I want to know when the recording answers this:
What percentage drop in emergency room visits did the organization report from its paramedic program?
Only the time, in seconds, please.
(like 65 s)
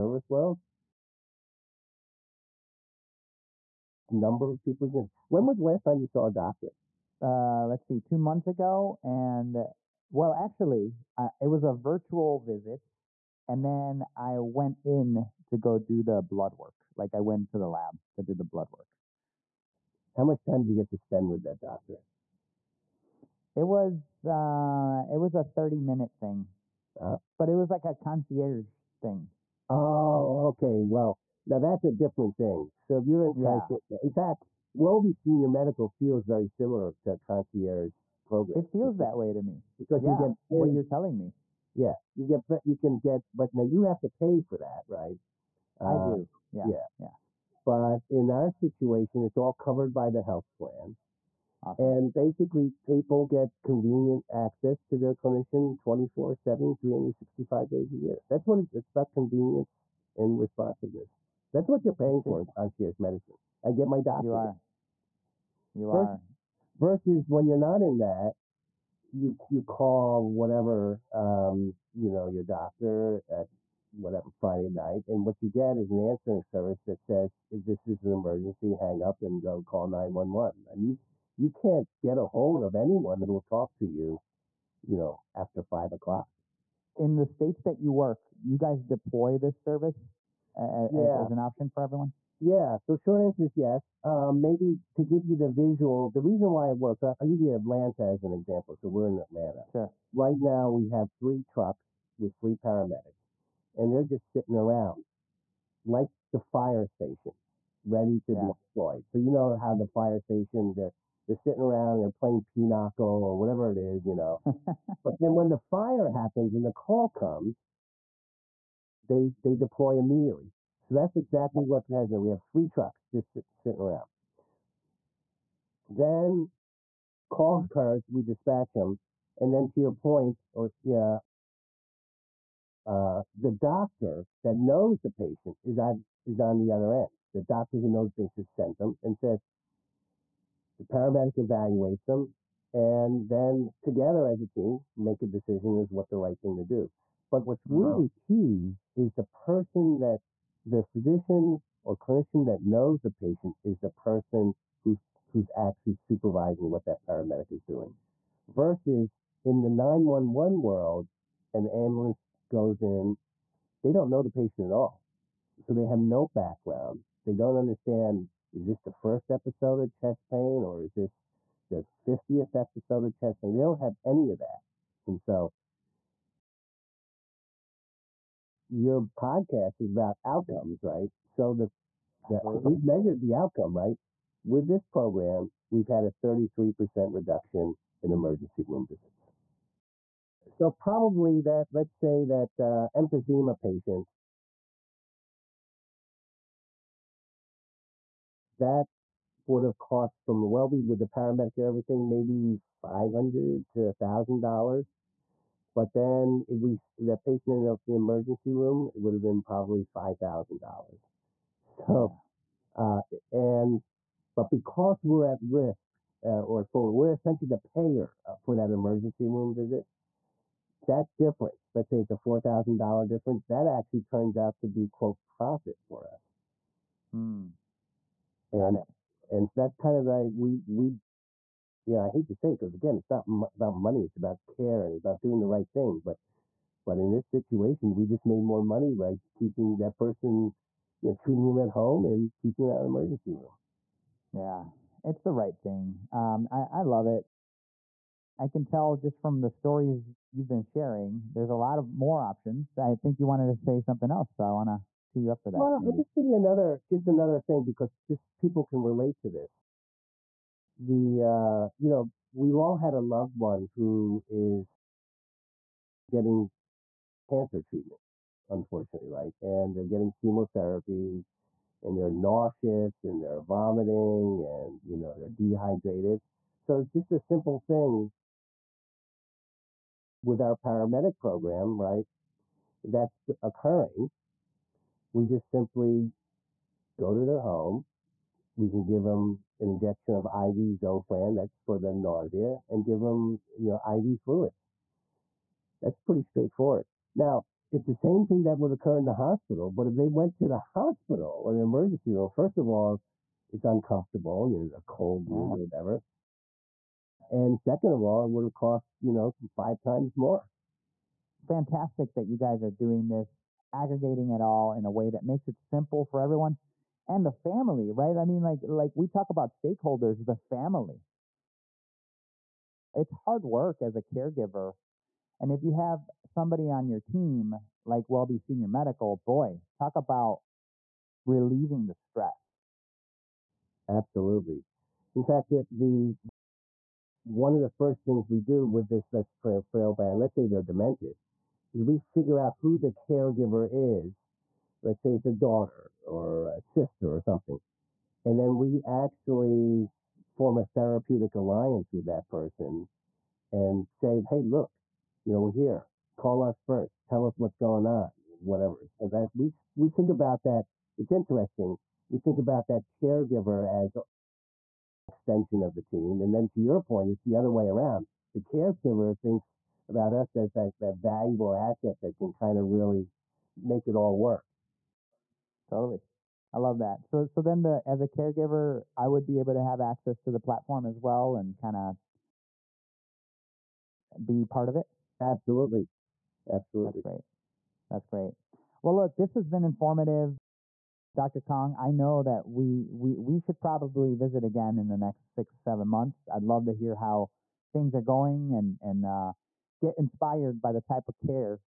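186 s.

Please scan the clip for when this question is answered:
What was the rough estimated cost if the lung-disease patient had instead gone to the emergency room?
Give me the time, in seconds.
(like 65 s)
209 s.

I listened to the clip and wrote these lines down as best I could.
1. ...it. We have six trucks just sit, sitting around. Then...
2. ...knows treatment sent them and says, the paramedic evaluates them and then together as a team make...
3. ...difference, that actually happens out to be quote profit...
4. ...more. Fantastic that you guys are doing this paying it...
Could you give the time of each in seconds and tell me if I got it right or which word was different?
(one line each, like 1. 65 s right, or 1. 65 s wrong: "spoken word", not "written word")
1. 122 s wrong: "three", not "six"
2. 137 s wrong: "patient", not "treatment"
3. 223 s wrong: "turns", not "happens"
4. 310 s wrong: "aggregating", not "paying".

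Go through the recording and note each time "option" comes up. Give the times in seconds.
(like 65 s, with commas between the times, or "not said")
91 s, 252 s.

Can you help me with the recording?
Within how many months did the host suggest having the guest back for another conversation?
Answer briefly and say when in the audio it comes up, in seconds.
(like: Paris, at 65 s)
6 or 7 months, at 395 s.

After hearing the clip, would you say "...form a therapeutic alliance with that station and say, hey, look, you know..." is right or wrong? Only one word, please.
wrong.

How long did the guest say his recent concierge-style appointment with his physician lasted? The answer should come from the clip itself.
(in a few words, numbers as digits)
30 minutes.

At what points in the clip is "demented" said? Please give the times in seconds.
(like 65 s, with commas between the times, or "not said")
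340 s.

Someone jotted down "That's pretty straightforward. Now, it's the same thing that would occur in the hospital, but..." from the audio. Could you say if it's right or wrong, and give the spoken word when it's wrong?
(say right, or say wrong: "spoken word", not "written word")
right.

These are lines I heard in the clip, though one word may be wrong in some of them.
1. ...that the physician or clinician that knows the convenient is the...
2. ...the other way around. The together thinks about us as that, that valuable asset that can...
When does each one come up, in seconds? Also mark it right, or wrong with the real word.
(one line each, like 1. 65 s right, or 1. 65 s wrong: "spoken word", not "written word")
1. 149 s wrong: "patient", not "convenient"
2. 367 s wrong: "caregiver", not "together".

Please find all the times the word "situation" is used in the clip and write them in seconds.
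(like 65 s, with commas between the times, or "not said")
48 s, 237 s.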